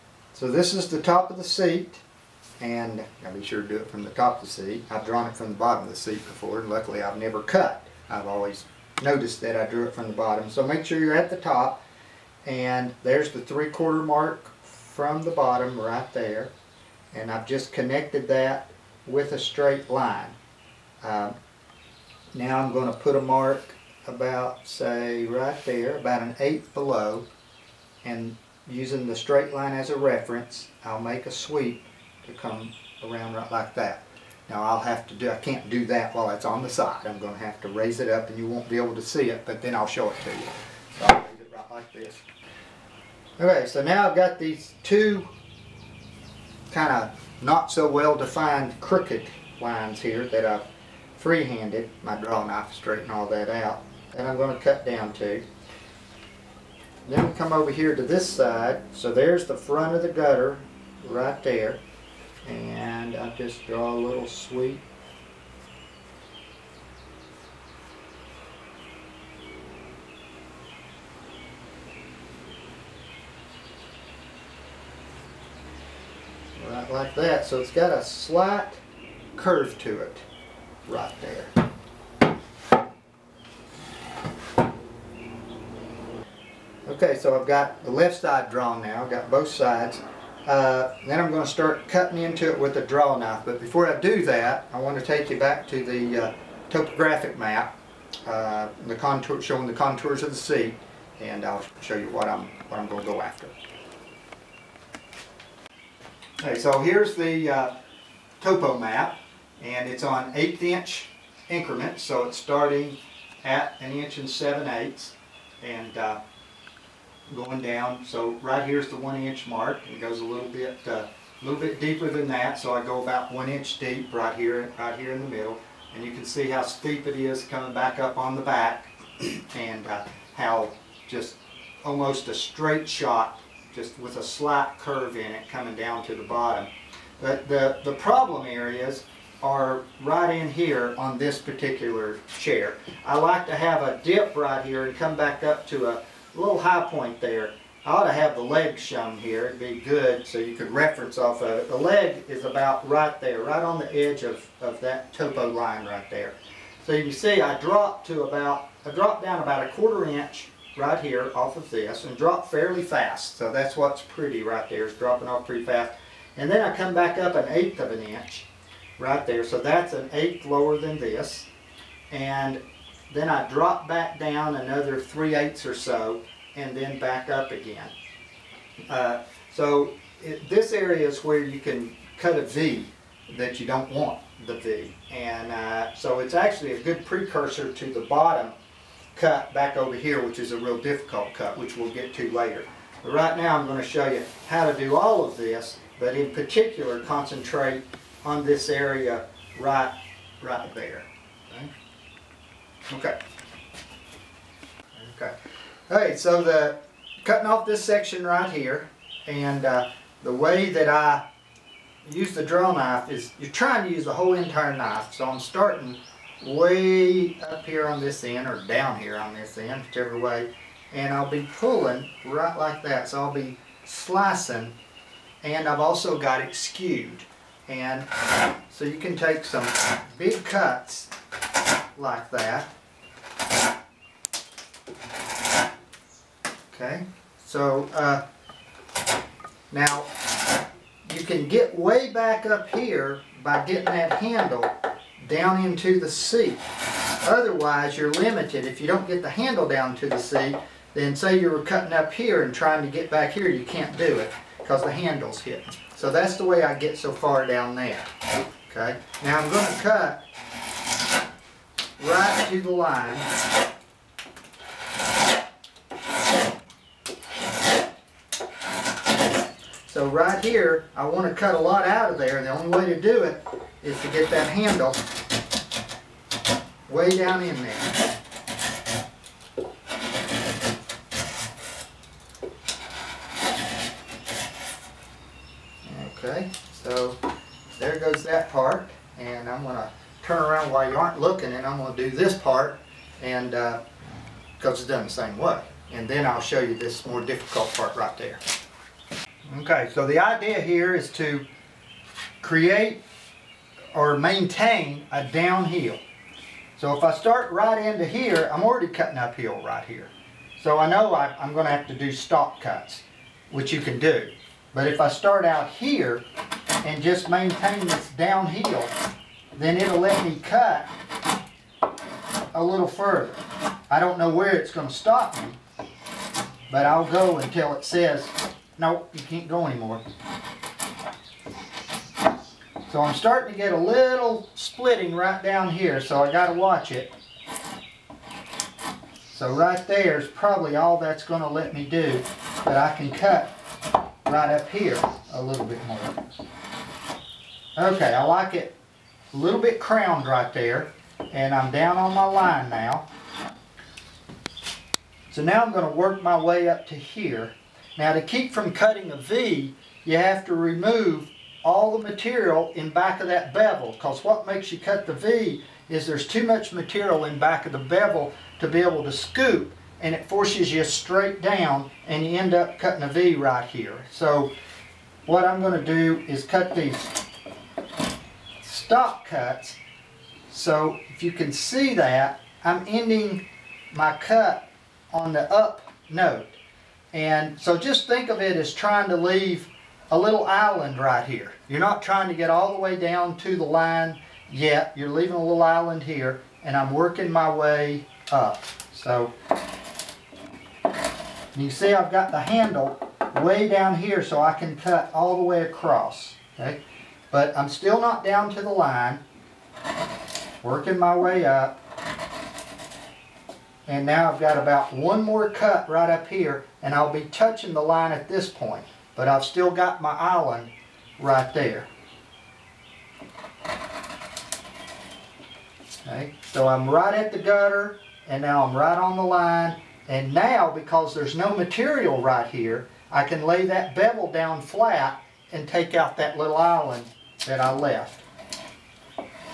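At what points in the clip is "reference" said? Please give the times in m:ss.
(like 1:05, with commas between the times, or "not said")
0:29, 2:30.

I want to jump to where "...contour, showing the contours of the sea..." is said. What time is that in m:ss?
1:38.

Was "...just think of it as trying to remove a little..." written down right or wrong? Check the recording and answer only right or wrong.
wrong.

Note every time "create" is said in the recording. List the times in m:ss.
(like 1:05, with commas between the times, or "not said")
5:02.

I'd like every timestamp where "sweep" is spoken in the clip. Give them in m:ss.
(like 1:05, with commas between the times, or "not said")
0:31, 1:04.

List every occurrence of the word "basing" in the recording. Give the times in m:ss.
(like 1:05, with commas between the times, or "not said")
not said.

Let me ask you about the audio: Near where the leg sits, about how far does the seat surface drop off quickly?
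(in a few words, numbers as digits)
1/4 inch.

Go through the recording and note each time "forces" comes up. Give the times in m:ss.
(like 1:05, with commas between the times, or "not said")
6:10.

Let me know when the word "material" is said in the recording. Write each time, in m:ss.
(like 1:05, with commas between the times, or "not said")
6:02, 6:06, 7:11.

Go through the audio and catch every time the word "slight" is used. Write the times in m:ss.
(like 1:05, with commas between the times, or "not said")
1:18, 2:14.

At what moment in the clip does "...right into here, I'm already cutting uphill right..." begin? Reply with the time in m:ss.
5:07.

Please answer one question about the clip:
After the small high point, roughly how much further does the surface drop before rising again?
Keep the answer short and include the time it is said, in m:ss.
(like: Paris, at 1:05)
3/8, at 2:54.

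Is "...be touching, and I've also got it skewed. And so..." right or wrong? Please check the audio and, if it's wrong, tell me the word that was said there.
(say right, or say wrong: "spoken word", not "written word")
wrong: "slicing", not "touching".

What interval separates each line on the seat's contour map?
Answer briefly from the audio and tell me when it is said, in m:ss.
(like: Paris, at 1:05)
1/8 inch, at 1:50.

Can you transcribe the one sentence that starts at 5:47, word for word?
Okay, I like it a little bit crowned right there, and I'm down on my line now.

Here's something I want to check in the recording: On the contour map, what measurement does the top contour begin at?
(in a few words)
1 7/8 inches.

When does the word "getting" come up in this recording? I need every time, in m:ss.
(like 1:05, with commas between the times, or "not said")
4:03.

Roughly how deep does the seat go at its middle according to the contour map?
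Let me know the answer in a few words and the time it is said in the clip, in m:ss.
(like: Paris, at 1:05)
1 inch, at 2:03.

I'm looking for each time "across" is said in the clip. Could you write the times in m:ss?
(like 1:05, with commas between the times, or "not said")
6:45.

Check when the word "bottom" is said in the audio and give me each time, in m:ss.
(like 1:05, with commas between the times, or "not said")
0:05, 0:10, 0:15, 2:16, 3:08.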